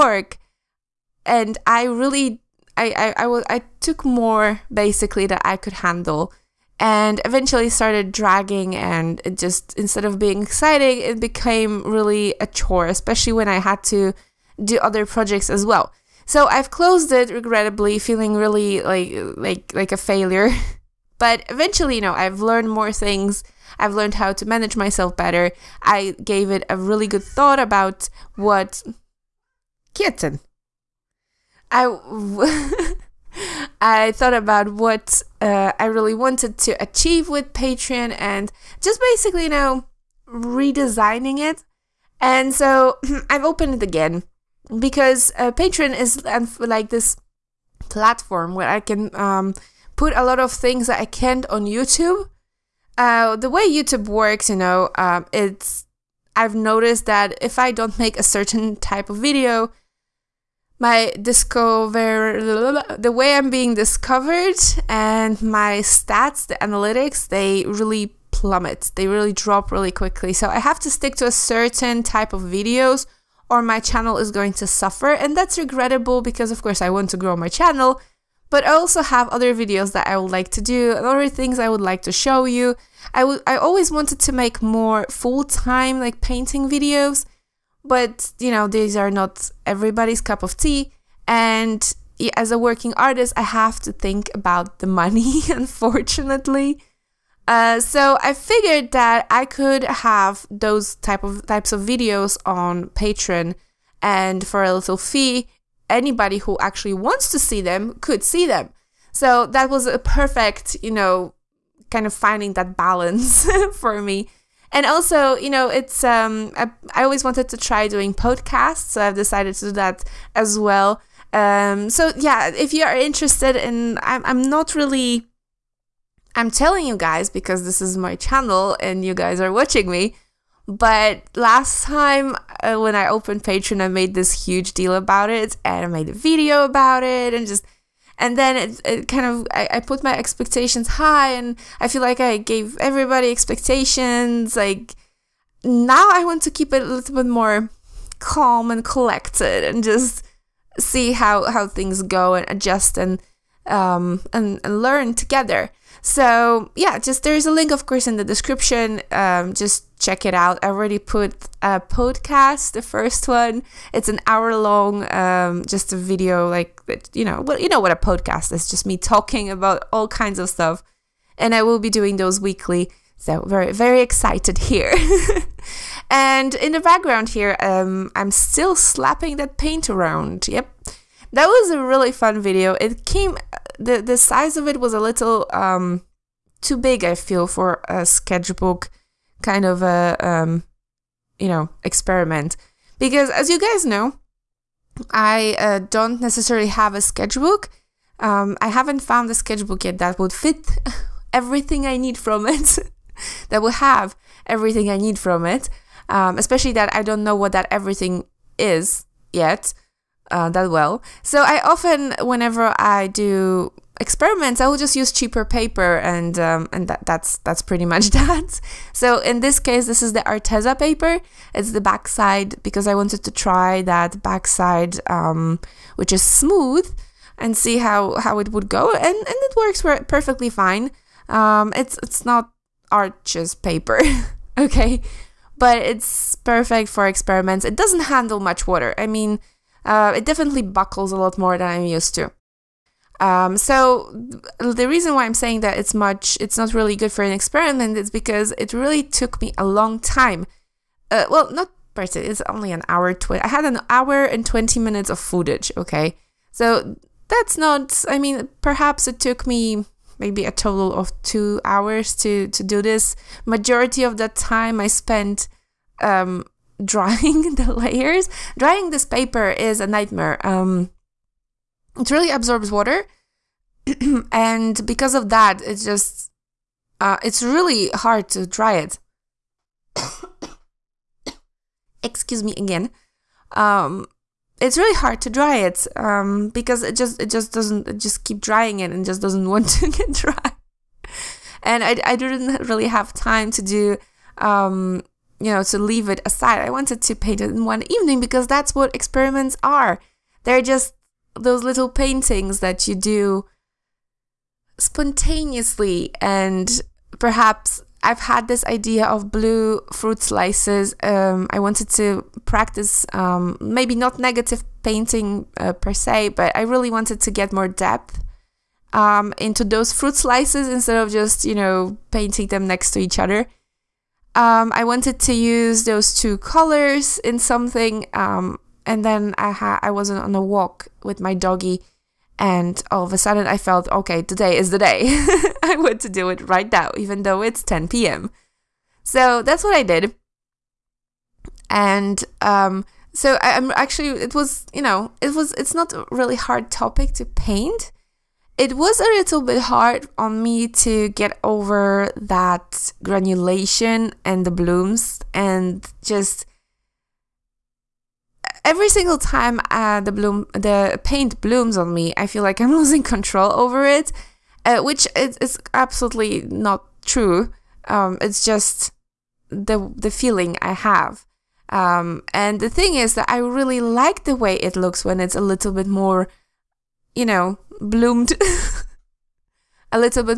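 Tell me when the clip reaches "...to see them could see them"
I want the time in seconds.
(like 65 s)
107 s.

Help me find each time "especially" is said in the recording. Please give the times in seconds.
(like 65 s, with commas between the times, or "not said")
12 s, 206 s.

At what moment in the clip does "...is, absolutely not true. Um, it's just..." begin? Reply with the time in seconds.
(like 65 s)
365 s.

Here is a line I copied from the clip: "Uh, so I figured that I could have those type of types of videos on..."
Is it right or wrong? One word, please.
right.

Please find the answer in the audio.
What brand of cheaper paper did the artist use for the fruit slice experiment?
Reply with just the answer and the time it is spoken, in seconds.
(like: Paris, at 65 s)
Arteza, at 220 s.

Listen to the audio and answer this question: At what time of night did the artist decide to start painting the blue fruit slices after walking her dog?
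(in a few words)
10 p.m.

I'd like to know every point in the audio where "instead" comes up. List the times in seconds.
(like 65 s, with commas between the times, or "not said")
9 s, 320 s.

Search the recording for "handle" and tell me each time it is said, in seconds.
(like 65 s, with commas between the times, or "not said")
5 s, 238 s.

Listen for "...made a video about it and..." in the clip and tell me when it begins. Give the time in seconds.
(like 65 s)
135 s.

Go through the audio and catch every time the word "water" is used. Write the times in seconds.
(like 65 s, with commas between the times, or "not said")
238 s, 272 s.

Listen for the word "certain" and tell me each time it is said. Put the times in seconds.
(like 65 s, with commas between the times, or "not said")
58 s, 71 s.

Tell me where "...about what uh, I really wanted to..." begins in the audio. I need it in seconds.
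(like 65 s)
34 s.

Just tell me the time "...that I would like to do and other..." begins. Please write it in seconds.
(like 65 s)
79 s.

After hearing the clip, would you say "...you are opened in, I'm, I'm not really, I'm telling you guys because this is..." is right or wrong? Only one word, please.
wrong.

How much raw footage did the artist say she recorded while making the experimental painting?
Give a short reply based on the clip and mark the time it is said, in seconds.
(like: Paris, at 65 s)
1 hour 20 minutes, at 253 s.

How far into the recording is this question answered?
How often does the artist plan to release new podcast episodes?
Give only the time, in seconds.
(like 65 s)
172 s.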